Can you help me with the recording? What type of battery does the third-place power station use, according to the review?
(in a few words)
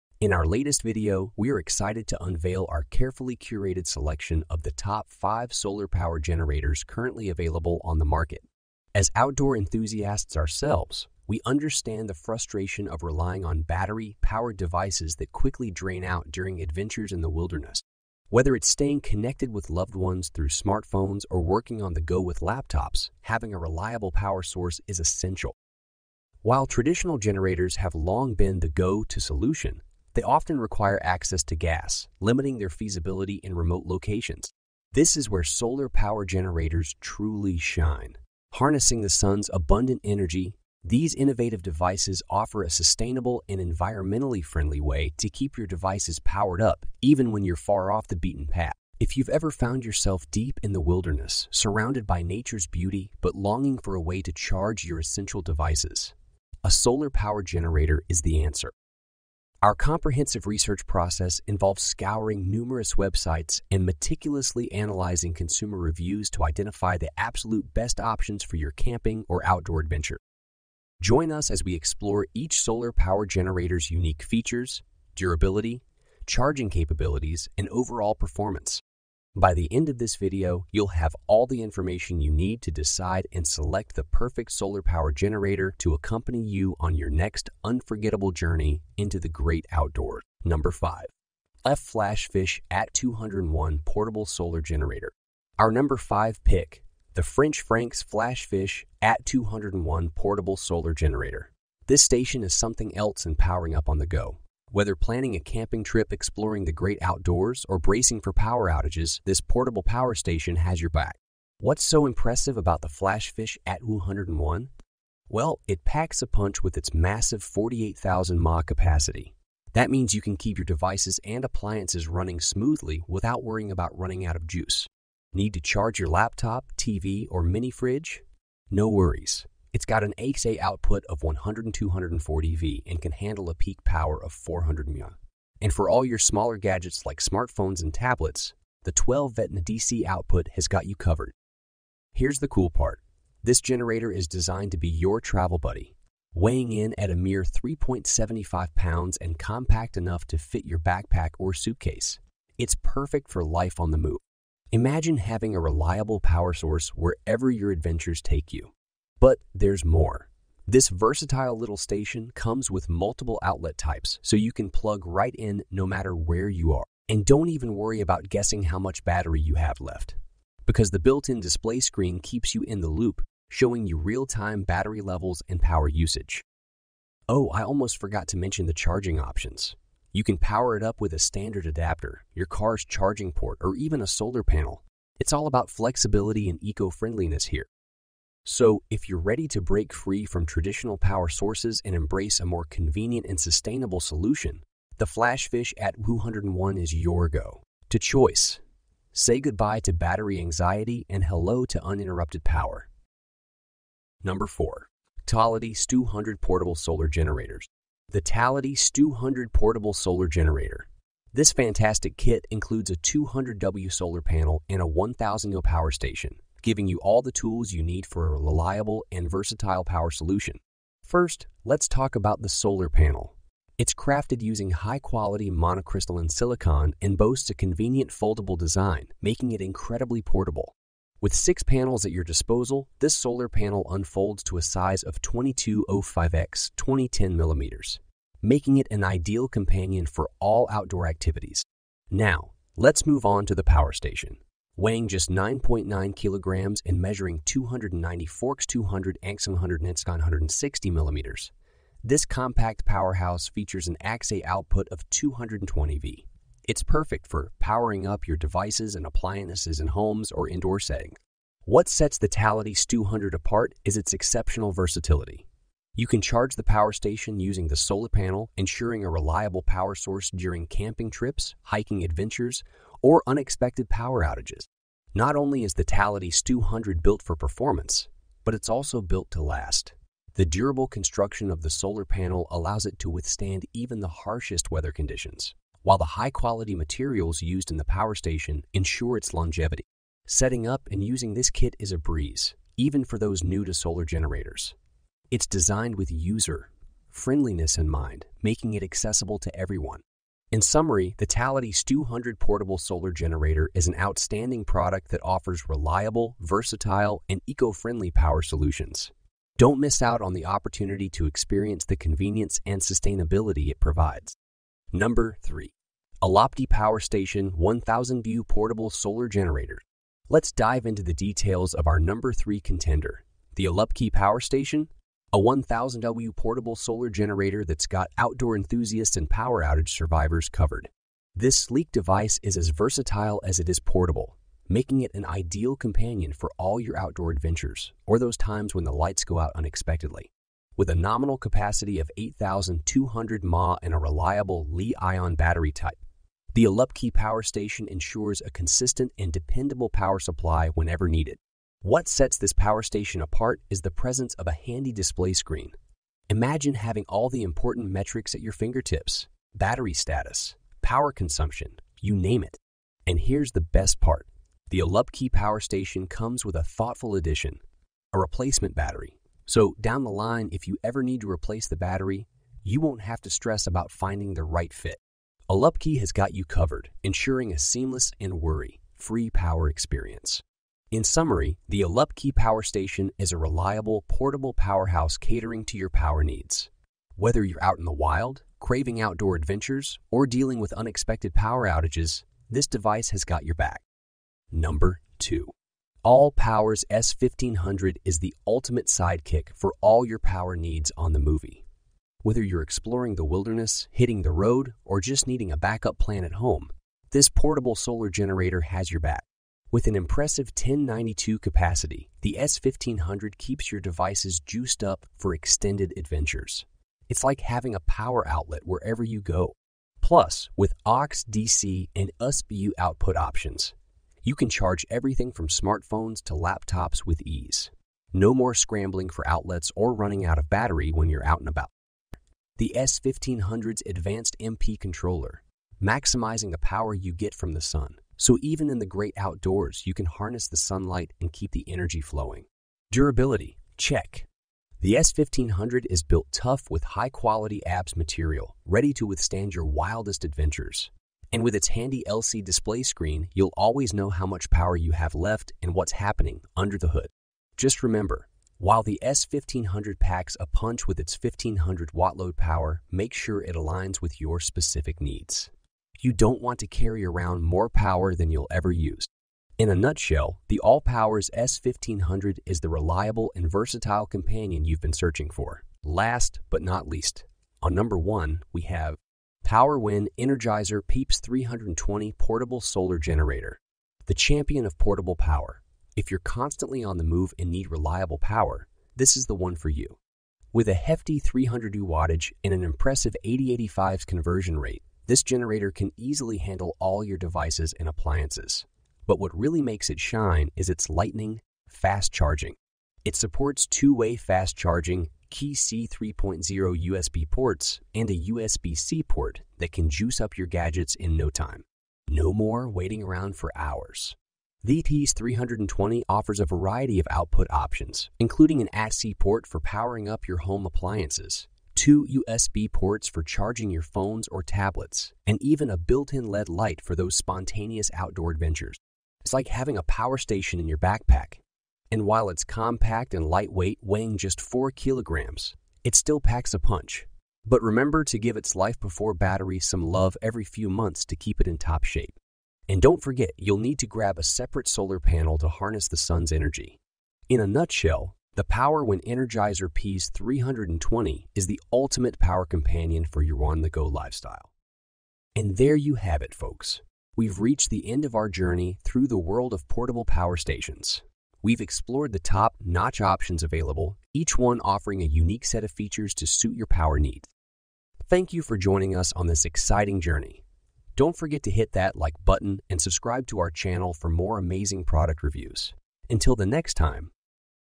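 Li-ion.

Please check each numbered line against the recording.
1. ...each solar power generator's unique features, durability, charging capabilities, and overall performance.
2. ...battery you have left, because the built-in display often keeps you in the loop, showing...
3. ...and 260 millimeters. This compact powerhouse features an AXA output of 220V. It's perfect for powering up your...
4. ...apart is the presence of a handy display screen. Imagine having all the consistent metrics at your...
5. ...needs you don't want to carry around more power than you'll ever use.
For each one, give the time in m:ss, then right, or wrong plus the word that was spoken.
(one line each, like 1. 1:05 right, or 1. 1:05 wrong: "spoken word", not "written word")
1. 1:12 right
2. 2:49 wrong: "screen", not "often"
3. 4:09 wrong: "160", not "260"
4. 5:53 wrong: "important", not "consistent"
5. 7:45 right.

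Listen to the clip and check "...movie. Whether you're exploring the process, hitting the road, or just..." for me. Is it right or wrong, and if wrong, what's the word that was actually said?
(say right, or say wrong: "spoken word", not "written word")
wrong: "wilderness", not "process".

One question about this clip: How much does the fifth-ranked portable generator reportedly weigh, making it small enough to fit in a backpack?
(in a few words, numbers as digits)
3.75 pounds.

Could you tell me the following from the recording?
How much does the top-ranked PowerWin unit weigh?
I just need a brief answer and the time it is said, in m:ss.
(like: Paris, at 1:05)
4 kilograms, at 8:54.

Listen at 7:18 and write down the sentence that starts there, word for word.
So even in the great outdoors, you can harness the sunlight and keep the energy flowing.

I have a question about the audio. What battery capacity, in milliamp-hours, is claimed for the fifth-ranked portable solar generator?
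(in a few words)
48,000 mAh.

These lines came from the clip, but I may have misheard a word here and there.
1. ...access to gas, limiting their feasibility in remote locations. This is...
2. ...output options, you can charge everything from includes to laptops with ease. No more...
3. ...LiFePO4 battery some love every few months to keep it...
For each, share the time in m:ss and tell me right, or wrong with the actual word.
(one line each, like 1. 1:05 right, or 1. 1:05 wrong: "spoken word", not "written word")
1. 0:31 right
2. 7:02 wrong: "smartphones", not "includes"
3. 8:58 right.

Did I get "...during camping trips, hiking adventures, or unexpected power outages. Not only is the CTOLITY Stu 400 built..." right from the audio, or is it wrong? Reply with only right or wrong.
wrong.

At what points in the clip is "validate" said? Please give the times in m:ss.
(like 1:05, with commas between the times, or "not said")
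not said.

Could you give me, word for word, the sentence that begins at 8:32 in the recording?
No more waiting around for hours.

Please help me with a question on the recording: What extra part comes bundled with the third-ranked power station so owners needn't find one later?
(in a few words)
a replacement battery.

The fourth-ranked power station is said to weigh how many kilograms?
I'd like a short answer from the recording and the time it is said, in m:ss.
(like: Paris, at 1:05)
9.9 kilograms, at 4:05.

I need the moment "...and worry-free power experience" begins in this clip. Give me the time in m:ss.
6:18.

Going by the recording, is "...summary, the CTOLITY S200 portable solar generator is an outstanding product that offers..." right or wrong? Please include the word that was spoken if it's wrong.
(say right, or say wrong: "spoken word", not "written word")
right.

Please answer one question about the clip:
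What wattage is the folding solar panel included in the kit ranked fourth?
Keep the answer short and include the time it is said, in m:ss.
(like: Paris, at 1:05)
200W, at 3:32.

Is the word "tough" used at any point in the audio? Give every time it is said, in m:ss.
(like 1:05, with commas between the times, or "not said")
7:26.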